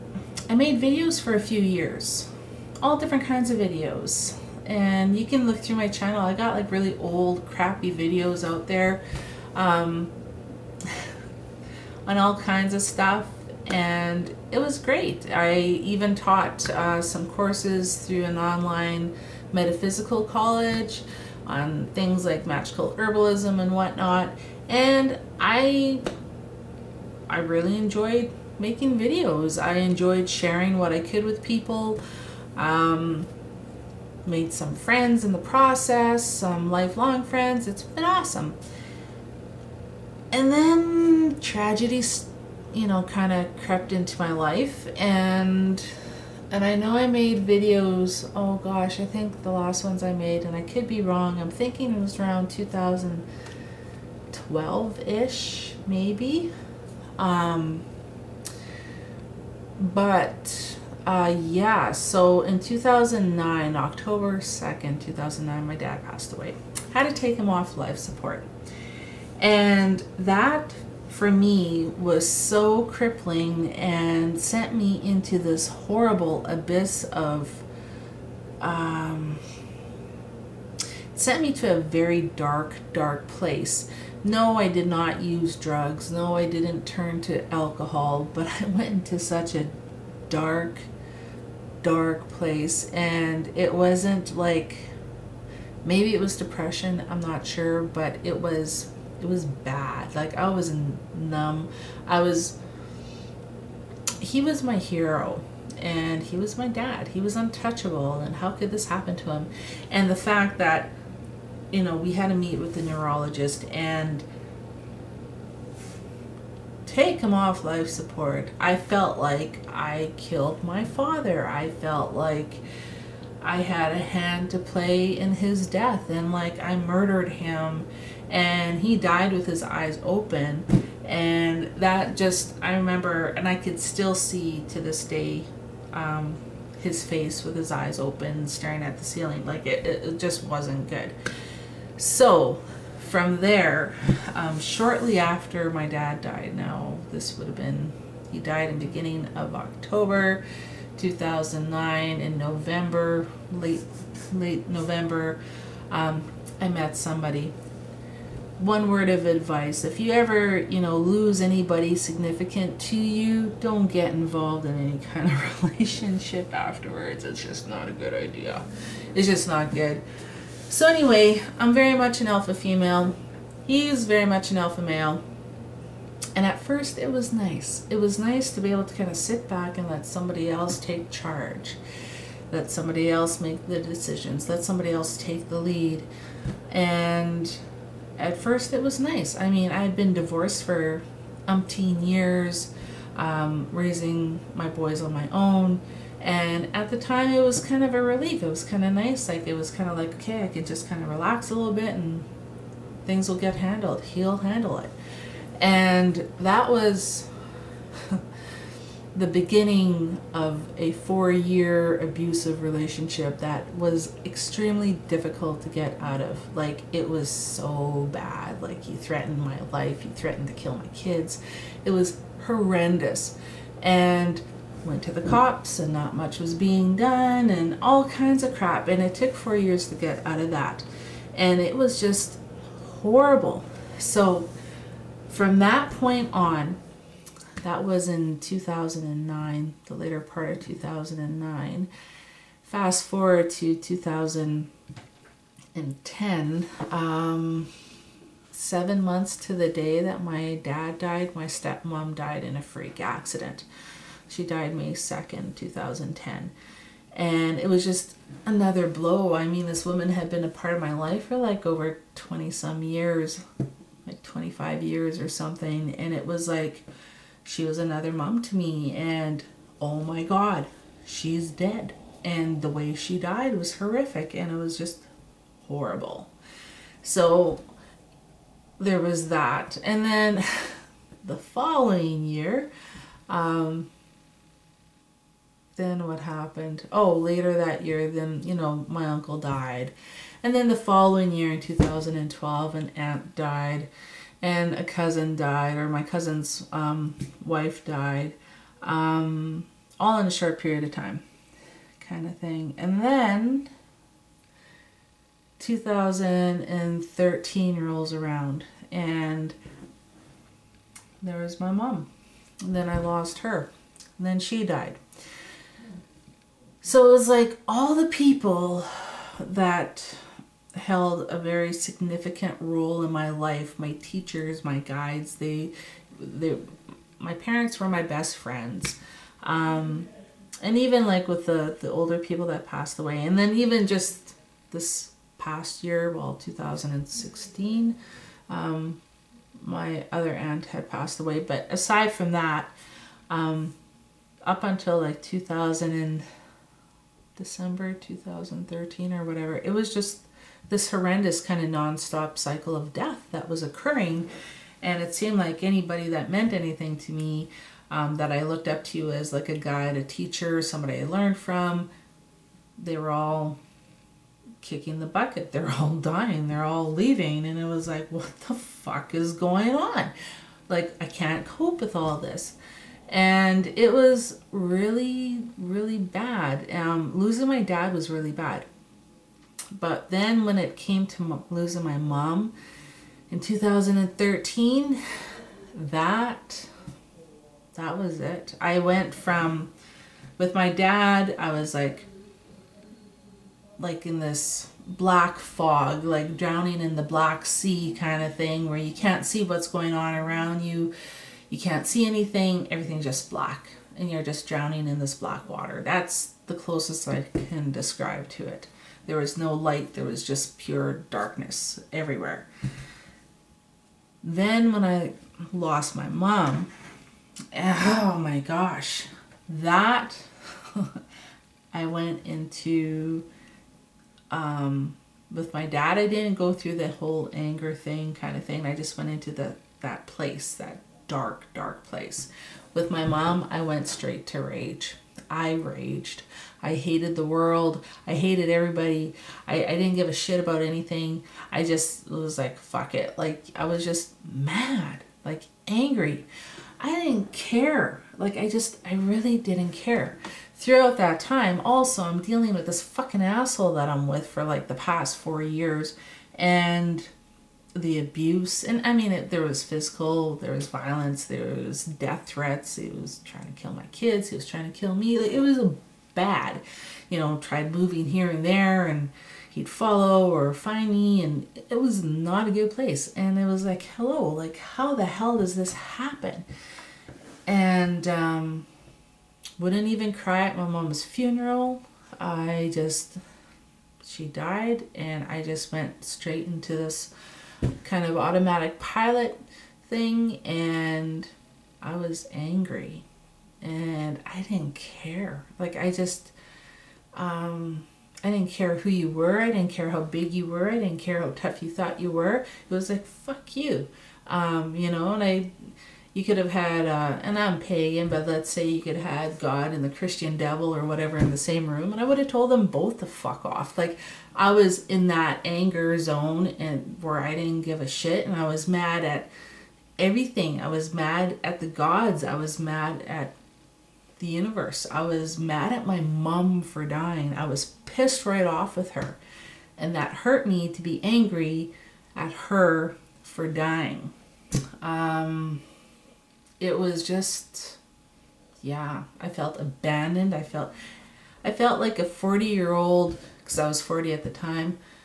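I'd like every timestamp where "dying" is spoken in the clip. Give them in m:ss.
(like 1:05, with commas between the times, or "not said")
6:05, 8:46, 8:53.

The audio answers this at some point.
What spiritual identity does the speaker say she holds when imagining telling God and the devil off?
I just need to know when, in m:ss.
8:27.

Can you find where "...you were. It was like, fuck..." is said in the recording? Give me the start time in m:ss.
8:21.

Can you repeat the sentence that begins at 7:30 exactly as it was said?
Throughout that time, also, I'm dealing with this fucking asshole that I'm with for like the past four years.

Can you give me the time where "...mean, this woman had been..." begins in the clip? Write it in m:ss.
4:19.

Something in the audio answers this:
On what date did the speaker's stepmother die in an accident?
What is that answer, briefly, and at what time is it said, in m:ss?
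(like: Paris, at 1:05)
May 2nd, 2010, at 4:14.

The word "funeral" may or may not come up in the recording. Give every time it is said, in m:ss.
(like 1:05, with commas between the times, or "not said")
8:01.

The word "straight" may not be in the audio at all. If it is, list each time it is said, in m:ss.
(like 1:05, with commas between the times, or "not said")
7:13, 8:06.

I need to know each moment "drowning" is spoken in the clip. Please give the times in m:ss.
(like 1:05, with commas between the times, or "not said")
6:36, 6:44.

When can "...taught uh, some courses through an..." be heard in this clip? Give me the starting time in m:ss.
0:16.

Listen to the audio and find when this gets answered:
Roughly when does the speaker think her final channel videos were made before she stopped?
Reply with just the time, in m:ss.
0:52.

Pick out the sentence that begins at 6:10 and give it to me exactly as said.
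Like, I can't cope with all this.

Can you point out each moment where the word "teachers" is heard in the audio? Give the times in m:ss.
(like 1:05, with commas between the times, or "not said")
5:24, 6:00.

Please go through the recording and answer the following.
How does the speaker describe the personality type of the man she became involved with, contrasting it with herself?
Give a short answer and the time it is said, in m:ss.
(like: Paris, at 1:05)
alpha male, at 2:54.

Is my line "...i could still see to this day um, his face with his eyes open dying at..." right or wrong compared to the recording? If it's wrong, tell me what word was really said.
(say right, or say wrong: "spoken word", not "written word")
wrong: "staring", not "dying".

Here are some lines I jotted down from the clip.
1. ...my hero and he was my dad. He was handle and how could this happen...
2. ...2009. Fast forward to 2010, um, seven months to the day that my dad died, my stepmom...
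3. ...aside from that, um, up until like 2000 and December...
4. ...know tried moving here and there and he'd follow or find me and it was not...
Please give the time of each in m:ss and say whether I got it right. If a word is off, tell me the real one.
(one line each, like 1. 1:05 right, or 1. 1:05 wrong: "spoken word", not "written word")
1. 1:44 wrong: "untouchable", not "handle"
2. 4:00 right
3. 5:41 right
4. 7:47 right.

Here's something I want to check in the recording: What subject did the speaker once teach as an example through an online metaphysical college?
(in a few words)
magical herbalism.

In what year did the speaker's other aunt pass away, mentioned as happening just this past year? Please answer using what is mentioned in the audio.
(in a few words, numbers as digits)
2016.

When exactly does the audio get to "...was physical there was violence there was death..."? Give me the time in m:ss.
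7:39.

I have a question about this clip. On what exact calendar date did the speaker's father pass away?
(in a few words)
October 2nd.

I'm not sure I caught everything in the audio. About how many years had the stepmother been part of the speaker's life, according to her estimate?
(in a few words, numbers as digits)
25 years.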